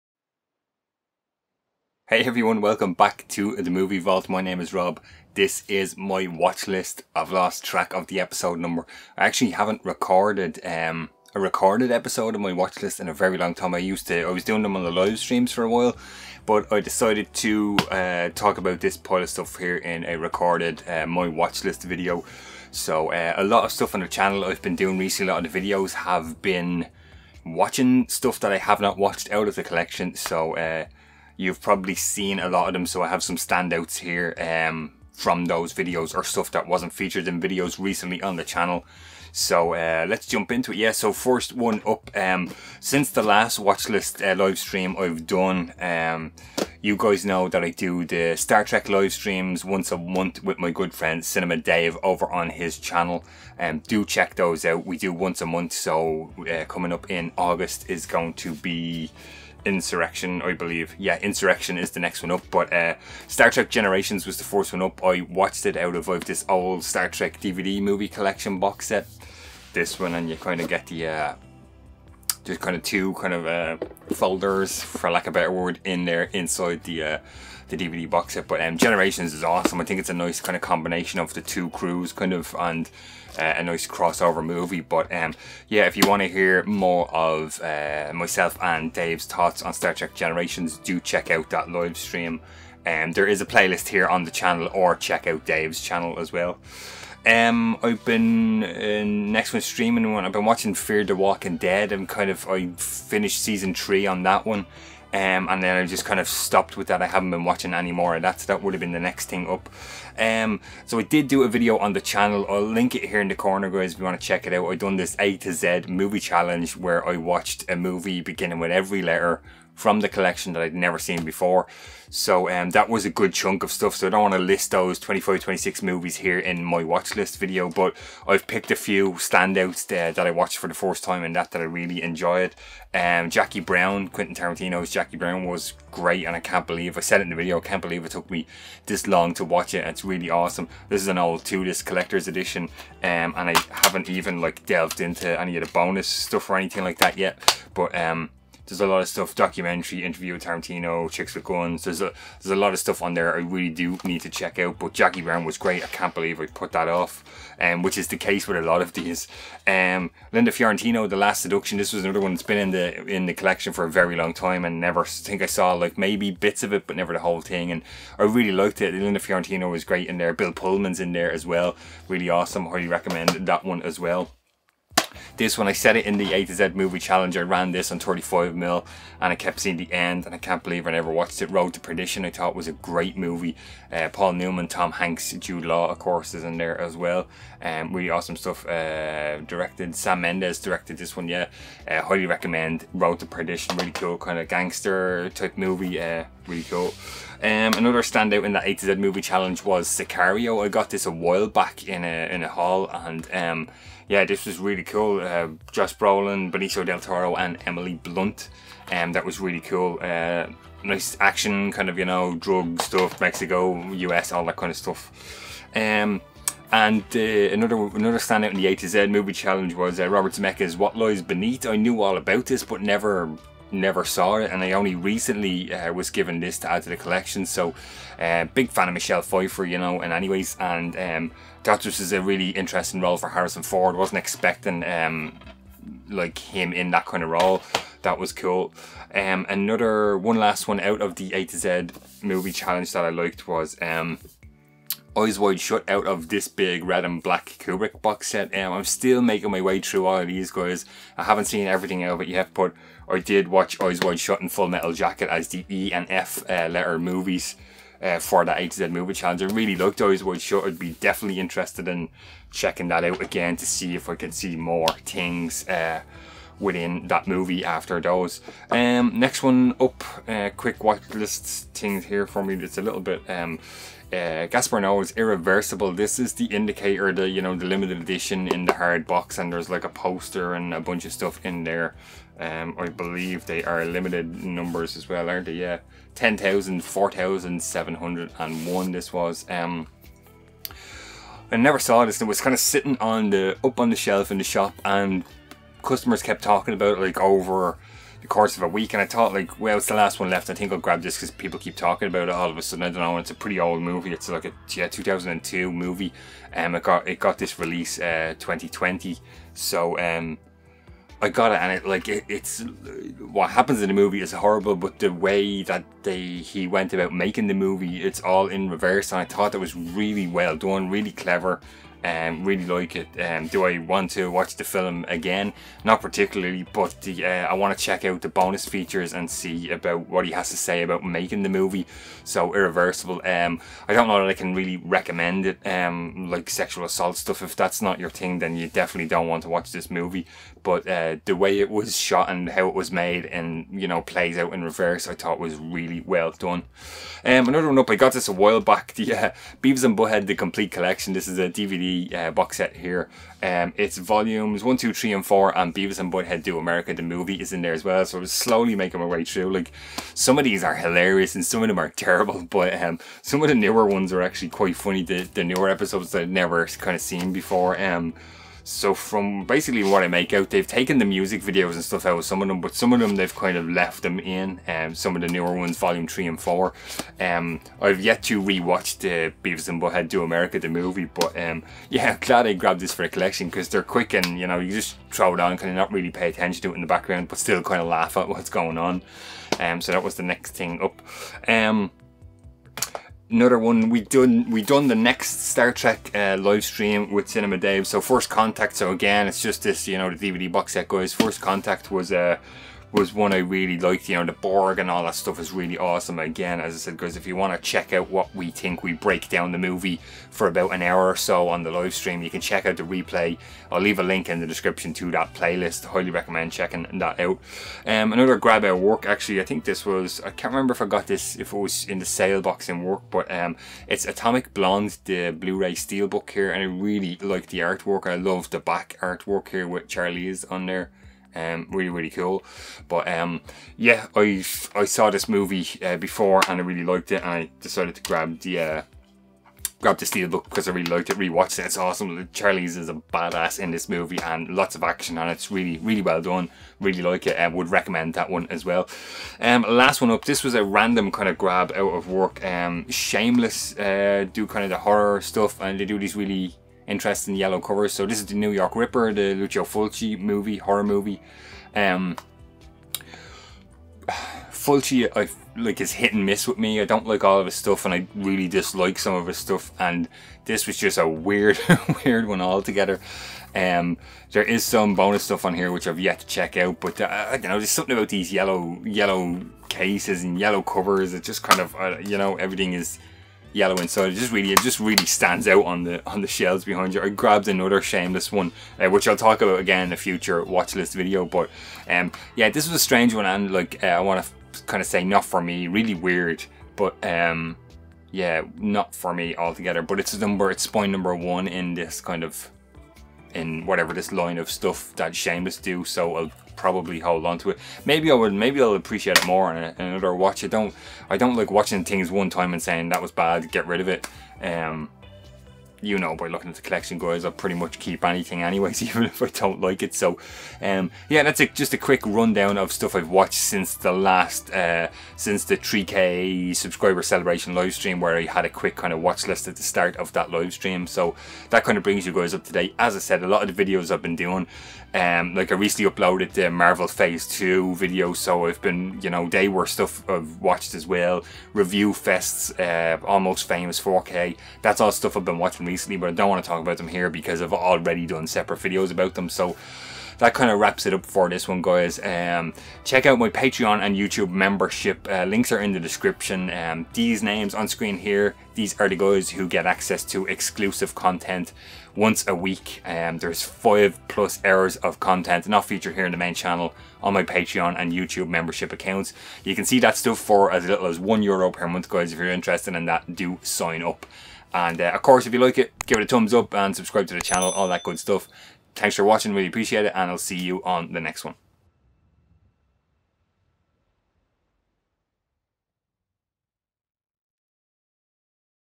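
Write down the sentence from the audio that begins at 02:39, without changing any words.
Um, Linda Fiorentino, The Last Seduction.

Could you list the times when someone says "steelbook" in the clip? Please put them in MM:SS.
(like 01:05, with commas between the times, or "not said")
07:05, 07:20.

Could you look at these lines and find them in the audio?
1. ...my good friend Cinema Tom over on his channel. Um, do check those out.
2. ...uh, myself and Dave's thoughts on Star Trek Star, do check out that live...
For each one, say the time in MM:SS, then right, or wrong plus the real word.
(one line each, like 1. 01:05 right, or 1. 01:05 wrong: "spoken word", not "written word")
1. 00:50 wrong: "Dave", not "Tom"
2. 01:27 wrong: "Generations", not "Star".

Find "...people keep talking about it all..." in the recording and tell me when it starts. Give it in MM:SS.
05:01.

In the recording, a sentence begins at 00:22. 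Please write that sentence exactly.
So uh, a lot of stuff on the channel I've been doing recently.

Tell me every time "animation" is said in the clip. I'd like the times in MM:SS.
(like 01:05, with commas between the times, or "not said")
not said.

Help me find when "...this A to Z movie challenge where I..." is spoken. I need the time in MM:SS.
01:54.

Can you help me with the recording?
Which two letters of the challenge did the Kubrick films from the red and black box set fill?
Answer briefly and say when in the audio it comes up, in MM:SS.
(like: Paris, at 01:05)
E and F, at 04:15.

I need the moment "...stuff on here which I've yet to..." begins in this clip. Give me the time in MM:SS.
07:55.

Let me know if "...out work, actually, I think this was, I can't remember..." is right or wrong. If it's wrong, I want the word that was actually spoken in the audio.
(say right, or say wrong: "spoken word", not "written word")
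right.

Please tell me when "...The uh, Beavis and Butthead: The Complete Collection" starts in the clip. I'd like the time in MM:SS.
05:49.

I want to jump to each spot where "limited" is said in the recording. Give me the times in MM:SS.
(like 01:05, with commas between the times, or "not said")
04:37, 04:43.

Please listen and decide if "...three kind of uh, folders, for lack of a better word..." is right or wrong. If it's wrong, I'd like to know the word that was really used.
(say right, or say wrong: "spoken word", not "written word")
wrong: "two", not "three".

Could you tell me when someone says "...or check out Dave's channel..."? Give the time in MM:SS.
01:34.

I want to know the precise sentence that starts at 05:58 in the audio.
So I am slowly making my way through.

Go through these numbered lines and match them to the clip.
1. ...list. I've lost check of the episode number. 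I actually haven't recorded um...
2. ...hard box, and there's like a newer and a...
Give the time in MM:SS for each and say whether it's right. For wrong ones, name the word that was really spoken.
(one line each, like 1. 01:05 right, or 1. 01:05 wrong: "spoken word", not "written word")
1. 00:06 wrong: "track", not "check"
2. 04:38 wrong: "poster", not "newer".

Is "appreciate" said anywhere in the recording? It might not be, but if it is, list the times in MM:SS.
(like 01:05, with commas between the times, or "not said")
08:28, 09:39.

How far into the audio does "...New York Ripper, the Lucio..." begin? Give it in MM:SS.
07:38.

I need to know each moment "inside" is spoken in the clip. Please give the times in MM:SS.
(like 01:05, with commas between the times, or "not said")
01:16, 08:03.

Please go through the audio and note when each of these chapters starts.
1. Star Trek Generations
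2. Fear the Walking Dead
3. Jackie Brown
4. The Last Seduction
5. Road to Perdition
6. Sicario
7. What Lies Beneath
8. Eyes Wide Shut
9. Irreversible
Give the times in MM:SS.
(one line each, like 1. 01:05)
1. 00:40
2. 01:38
3. 02:13
4. 02:41
5. 02:55
6. 03:17
7. 03:36
8. 04:00
9. 04:29.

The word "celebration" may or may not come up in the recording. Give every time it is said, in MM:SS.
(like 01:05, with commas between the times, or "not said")
08:47.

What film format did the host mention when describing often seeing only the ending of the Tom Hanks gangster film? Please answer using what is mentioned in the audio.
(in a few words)
35mm.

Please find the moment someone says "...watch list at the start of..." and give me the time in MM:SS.
08:49.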